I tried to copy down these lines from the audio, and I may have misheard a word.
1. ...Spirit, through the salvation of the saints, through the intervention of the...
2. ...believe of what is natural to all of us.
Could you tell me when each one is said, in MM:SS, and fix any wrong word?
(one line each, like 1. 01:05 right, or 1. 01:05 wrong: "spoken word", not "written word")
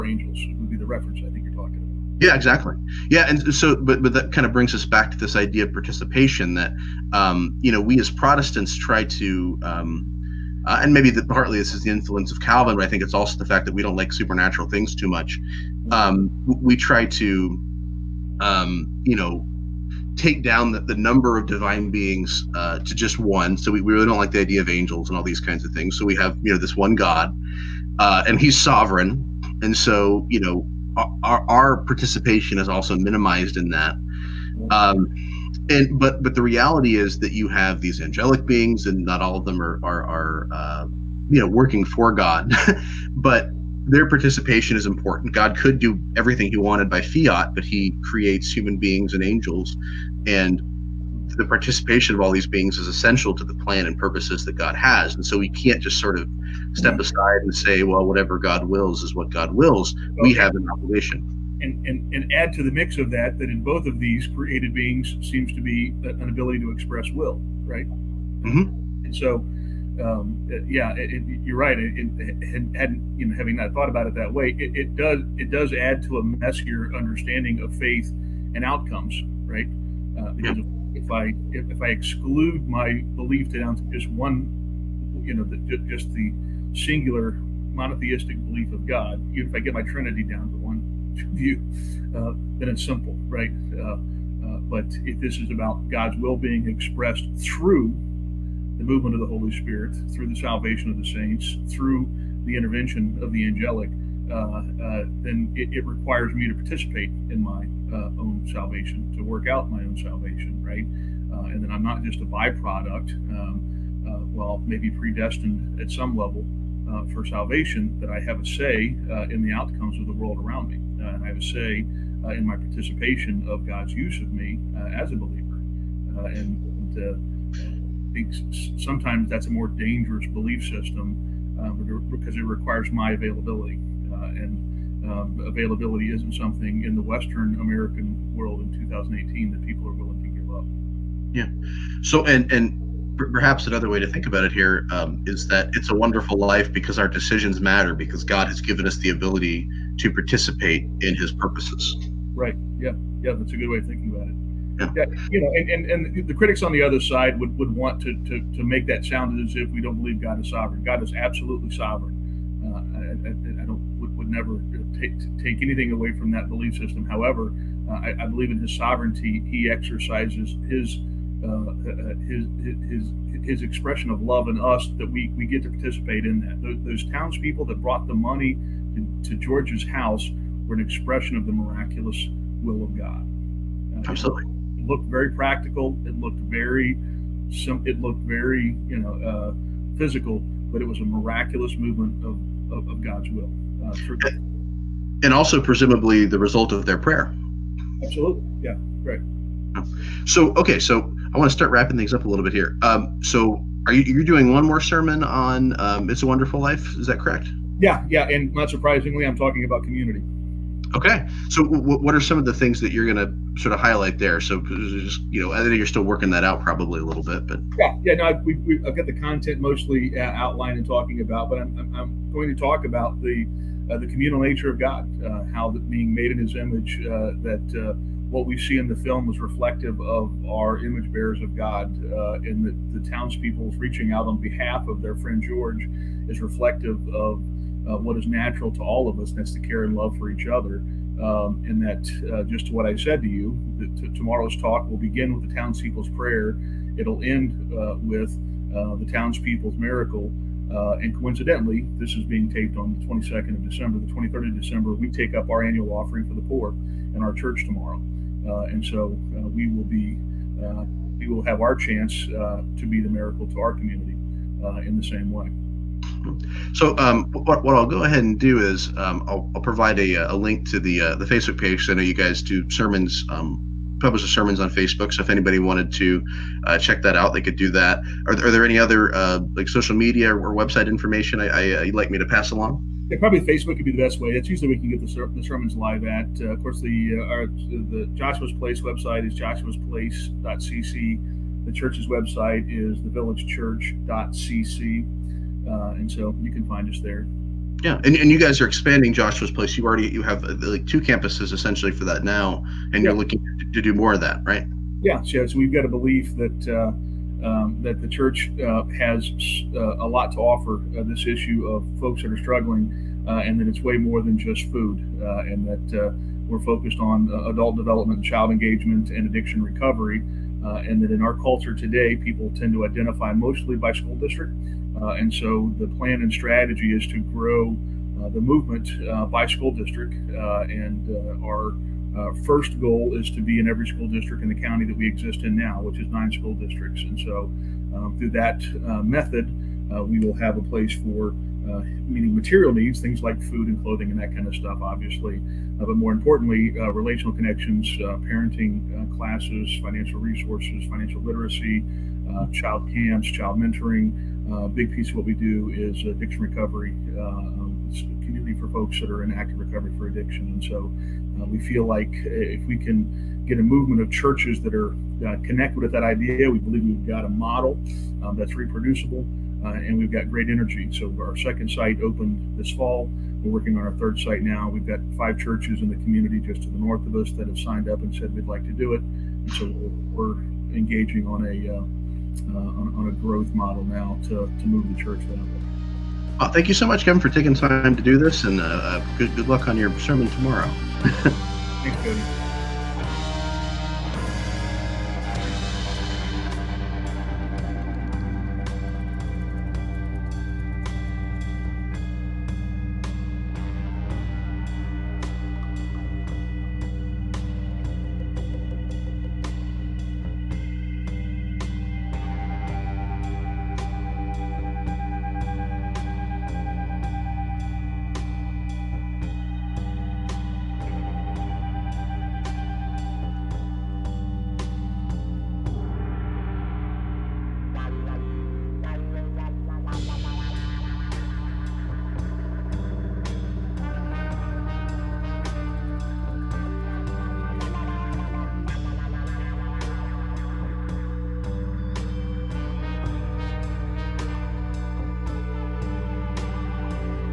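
1. 01:39 right
2. 03:56 wrong: "reflective", not "believe".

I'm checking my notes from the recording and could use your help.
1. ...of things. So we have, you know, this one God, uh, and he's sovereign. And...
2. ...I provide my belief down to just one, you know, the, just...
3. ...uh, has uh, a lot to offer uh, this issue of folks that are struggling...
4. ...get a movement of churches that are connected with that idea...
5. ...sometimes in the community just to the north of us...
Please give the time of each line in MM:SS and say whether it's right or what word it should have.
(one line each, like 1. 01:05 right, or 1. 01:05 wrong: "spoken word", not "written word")
1. 00:25 right
2. 01:21 wrong: "exclude", not "provide"
3. 05:08 right
4. 06:03 right
5. 06:15 wrong: "churches", not "sometimes".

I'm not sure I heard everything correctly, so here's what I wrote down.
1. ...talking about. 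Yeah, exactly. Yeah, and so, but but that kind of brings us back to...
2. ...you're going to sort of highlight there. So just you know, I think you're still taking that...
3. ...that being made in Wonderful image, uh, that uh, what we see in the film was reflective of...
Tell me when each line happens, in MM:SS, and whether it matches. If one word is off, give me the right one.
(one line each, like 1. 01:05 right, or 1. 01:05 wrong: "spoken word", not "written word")
1. 00:01 right
2. 03:32 wrong: "working", not "taking"
3. 03:45 wrong: "His", not "Wonderful".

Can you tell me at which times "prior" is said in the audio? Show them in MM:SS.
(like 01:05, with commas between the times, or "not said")
not said.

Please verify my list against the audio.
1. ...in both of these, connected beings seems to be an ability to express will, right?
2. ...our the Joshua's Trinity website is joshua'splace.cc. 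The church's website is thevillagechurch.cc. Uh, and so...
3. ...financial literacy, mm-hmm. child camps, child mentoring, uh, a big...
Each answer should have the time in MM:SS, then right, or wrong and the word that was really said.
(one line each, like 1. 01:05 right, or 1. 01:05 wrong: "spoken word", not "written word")
1. 01:03 wrong: "created", not "connected"
2. 04:47 wrong: "Place", not "Trinity"
3. 05:50 right.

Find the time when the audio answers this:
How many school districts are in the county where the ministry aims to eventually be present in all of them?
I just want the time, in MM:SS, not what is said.
05:36.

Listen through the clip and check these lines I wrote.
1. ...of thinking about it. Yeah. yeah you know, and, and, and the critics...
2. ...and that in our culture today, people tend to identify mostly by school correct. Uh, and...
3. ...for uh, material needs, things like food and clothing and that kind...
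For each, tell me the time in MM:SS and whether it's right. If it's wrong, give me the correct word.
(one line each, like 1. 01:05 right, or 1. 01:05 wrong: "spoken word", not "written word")
1. 02:33 right
2. 05:20 wrong: "district", not "correct"
3. 05:40 right.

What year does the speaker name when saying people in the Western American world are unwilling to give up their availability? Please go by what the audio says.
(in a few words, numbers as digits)
2018.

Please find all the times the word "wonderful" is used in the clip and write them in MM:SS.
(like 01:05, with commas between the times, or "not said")
02:25, 03:26.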